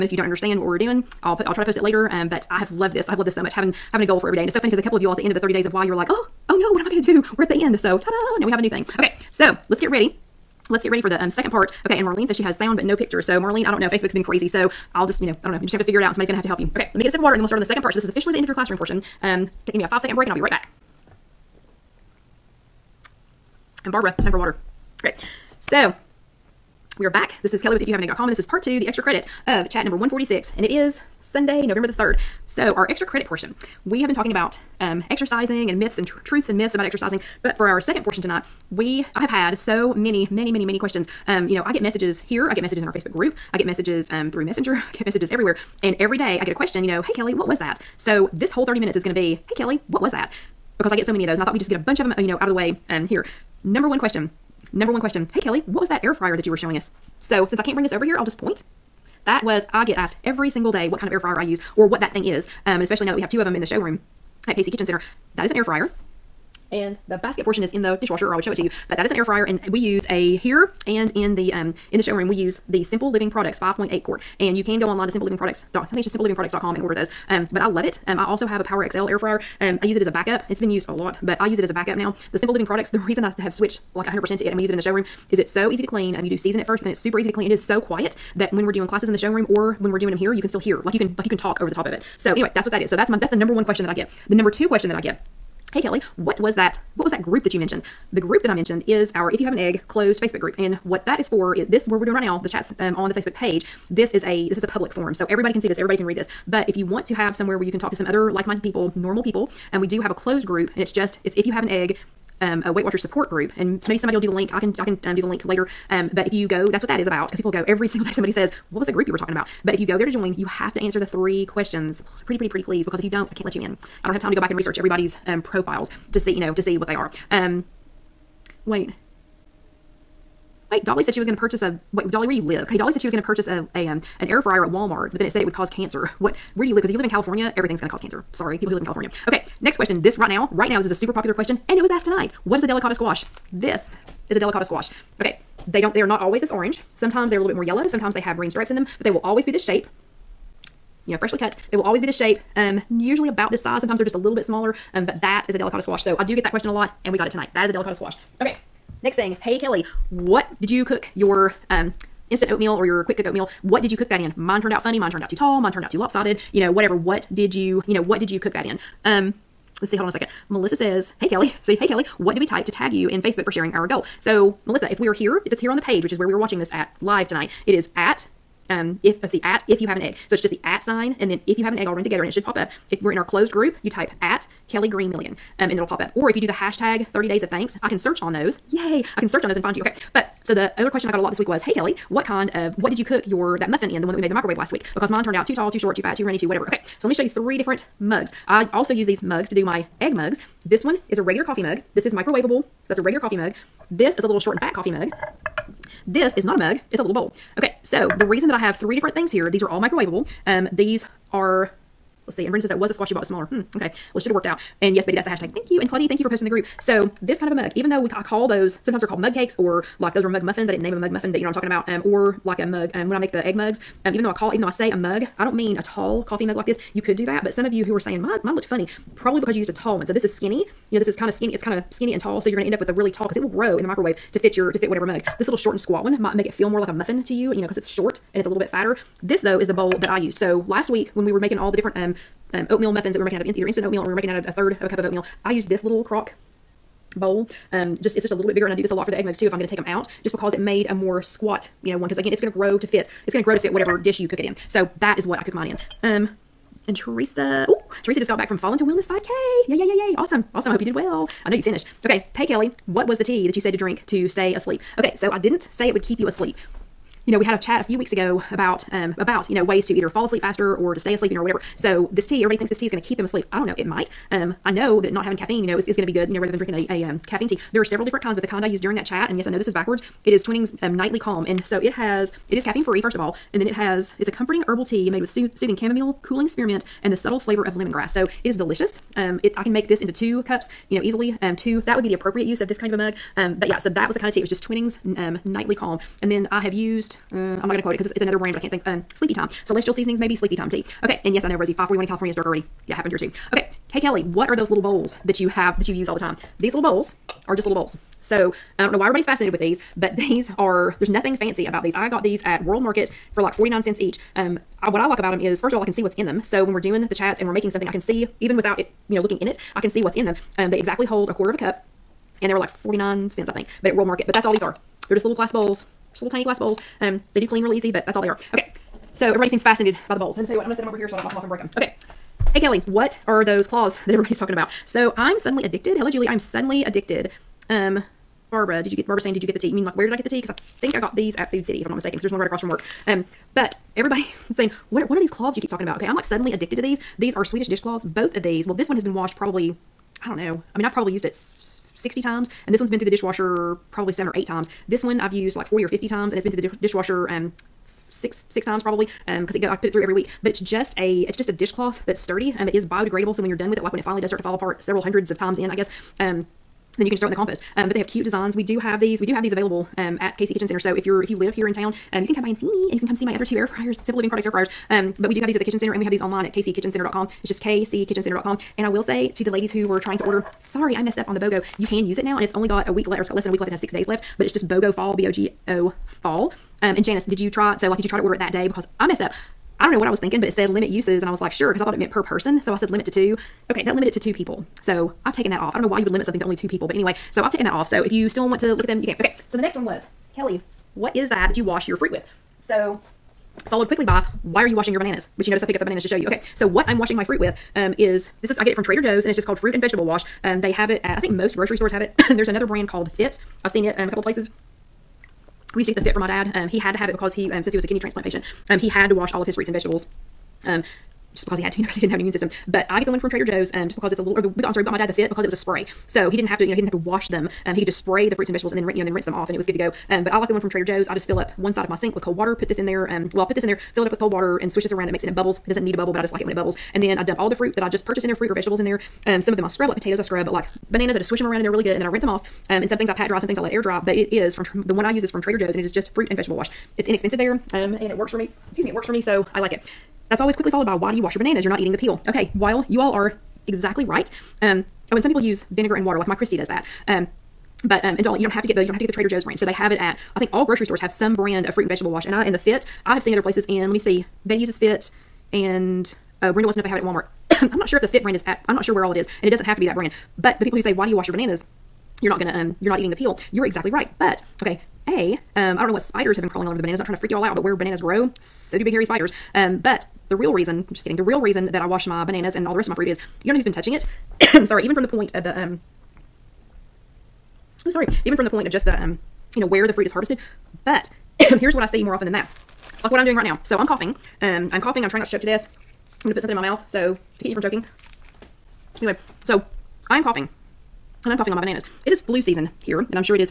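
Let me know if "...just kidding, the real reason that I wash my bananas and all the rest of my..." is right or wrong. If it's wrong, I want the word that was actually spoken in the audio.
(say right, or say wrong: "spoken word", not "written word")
right.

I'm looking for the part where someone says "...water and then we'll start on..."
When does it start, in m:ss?
0:17.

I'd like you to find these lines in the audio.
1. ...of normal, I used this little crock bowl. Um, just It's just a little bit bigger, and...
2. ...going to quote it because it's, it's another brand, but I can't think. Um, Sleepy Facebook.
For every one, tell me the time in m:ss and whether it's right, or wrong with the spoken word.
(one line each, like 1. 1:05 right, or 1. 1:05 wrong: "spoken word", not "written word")
1. 4:04 wrong: "oatmeal", not "normal"
2. 4:57 wrong: "Time", not "Facebook".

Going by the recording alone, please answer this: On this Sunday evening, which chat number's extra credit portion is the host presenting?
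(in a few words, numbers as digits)
146.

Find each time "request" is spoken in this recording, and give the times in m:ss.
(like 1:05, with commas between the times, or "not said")
not said.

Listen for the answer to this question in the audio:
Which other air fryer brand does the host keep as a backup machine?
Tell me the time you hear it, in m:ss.
1:18.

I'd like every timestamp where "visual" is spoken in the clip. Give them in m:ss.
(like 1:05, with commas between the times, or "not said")
not said.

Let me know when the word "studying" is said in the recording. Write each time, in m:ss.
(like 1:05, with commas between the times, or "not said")
not said.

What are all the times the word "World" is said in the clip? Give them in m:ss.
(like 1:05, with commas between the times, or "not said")
5:12, 5:23.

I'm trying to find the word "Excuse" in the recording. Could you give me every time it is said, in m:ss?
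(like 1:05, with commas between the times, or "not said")
7:28.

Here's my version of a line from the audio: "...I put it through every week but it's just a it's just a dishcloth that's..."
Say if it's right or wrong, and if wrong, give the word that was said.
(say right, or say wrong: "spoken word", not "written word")
right.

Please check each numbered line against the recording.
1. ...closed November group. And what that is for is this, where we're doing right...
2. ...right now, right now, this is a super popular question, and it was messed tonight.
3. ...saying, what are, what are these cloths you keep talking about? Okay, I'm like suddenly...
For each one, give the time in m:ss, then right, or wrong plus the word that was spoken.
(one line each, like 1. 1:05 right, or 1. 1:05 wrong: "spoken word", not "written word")
1. 1:39 wrong: "Facebook", not "November"
2. 2:20 wrong: "asked", not "messed"
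3. 5:44 right.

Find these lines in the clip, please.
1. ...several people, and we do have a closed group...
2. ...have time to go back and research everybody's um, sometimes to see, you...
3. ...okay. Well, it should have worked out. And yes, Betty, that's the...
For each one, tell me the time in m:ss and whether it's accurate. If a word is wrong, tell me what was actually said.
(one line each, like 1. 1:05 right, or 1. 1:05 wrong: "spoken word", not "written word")
1. 1:48 wrong: "normal", not "several"
2. 2:04 wrong: "profiles", not "sometimes"
3. 3:33 right.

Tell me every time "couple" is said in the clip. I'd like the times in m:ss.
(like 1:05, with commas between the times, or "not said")
0:04, 6:54.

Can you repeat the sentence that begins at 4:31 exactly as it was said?
So this tea, everybody thinks this tea is going to keep them asleep.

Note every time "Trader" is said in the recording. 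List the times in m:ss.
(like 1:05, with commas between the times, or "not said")
6:48, 7:03, 7:10, 7:25, 7:39.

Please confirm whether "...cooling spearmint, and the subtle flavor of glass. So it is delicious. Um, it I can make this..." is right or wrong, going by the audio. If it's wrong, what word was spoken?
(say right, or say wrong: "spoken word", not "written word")
wrong: "lemongrass", not "glass".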